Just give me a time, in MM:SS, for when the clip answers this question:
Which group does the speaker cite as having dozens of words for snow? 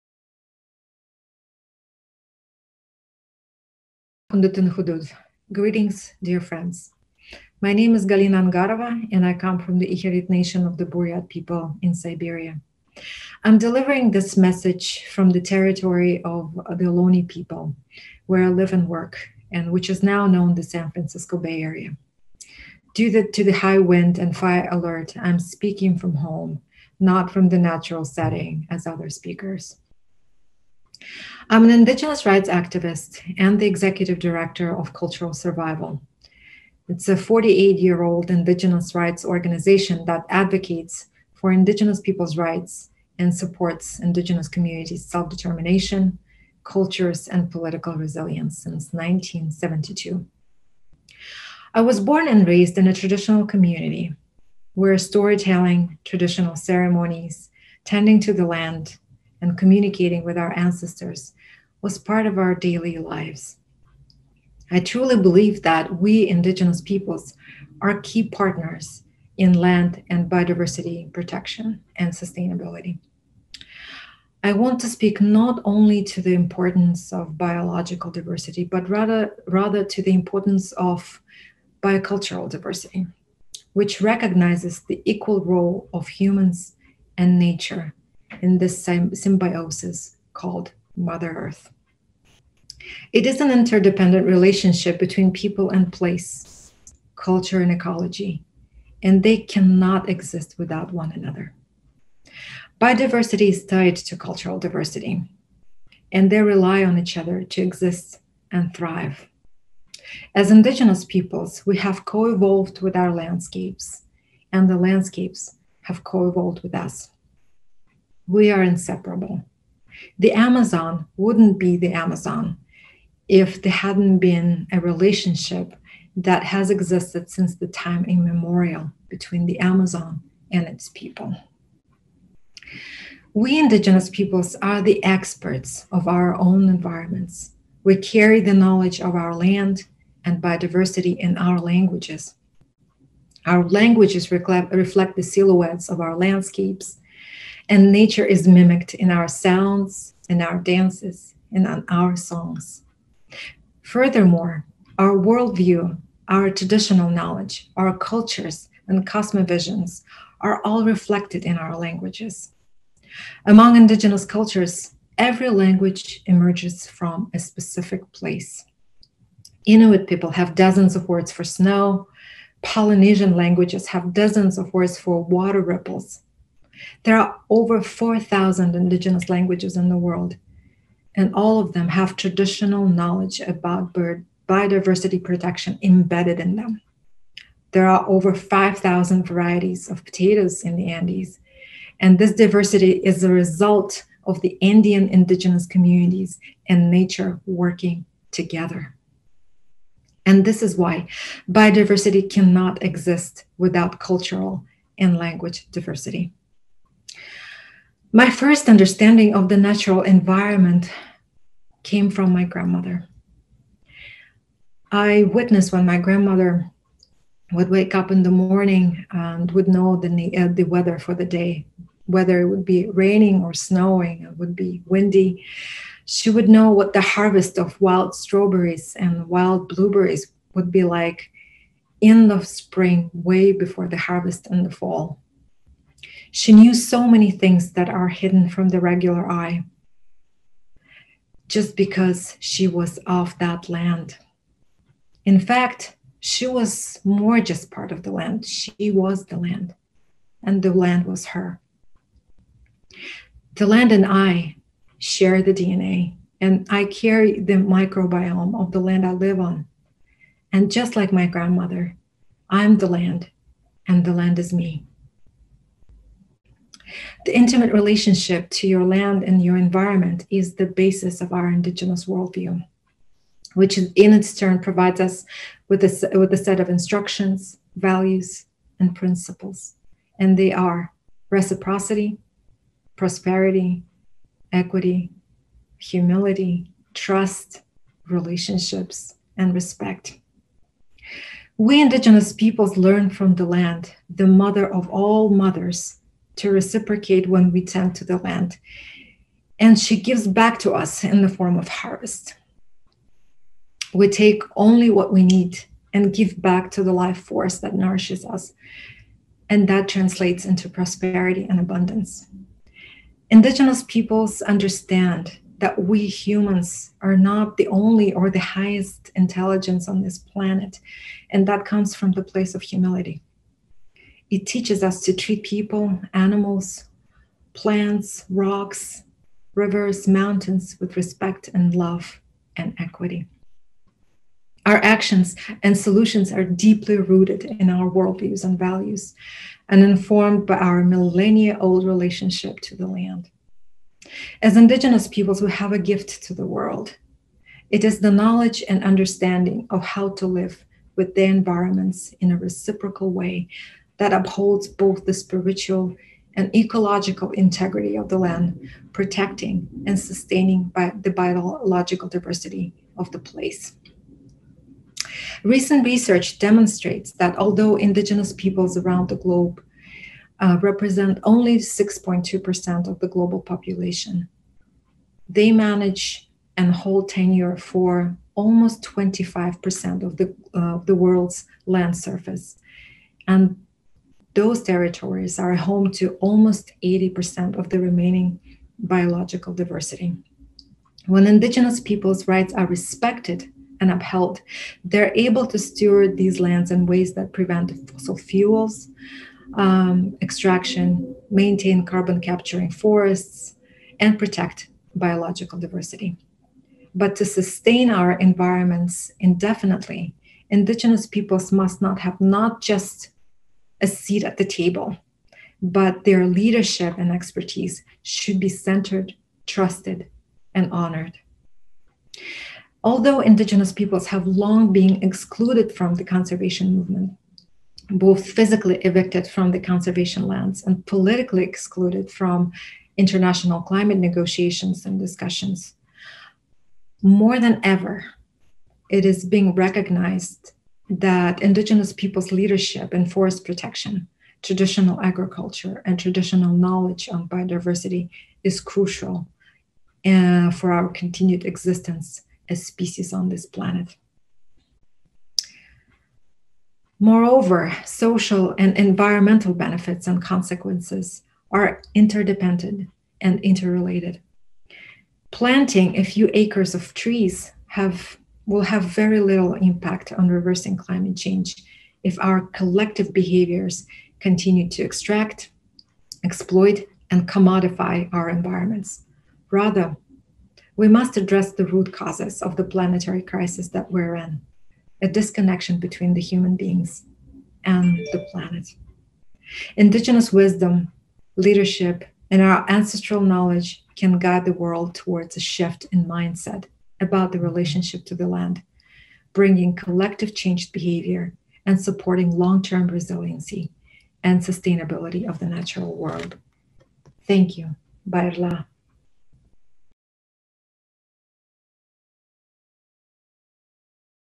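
02:49.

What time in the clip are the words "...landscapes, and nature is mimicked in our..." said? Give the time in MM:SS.
02:26.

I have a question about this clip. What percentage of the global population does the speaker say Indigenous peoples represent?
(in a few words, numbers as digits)
6.2%.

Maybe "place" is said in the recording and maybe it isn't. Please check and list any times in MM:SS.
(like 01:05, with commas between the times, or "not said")
01:35, 02:48, 05:22, 06:03.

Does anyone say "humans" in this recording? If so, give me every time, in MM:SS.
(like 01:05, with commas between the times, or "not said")
01:26, 05:16, 08:06.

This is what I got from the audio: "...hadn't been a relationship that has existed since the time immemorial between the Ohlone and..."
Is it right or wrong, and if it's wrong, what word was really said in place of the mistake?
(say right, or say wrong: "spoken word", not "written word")
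wrong: "Amazon", not "Ohlone".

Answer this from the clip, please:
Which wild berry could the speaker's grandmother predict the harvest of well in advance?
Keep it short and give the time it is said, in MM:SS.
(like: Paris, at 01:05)
wild strawberries, at 03:47.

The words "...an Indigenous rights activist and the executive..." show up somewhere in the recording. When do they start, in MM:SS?
00:31.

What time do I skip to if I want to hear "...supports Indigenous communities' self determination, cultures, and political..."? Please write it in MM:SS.
00:43.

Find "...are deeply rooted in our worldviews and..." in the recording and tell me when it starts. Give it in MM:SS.
05:36.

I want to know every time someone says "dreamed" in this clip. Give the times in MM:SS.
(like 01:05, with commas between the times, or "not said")
not said.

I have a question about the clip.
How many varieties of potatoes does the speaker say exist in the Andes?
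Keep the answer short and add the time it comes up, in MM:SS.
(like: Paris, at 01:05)
5,000, at 03:08.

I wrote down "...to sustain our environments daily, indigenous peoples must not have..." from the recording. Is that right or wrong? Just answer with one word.
wrong.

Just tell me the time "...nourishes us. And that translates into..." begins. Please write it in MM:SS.
05:07.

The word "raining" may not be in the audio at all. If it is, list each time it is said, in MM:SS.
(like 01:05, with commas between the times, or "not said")
03:42.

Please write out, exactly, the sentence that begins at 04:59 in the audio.
And she gives back to us in the form of harvest.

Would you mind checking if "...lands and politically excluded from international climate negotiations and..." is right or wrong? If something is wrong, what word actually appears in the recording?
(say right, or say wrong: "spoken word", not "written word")
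right.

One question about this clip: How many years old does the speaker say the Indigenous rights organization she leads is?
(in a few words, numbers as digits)
48.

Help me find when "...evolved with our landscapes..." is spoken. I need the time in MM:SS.
01:52.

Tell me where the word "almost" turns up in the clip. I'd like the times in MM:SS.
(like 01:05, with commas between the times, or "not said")
06:18, 06:26.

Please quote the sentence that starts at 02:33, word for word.
Furthermore, our worldview, our traditional knowledge, our cultures, and cosmovisions are all reflected in our languages.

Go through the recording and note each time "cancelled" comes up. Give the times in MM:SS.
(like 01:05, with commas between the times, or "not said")
not said.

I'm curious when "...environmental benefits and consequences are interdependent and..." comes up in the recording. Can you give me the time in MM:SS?
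07:38.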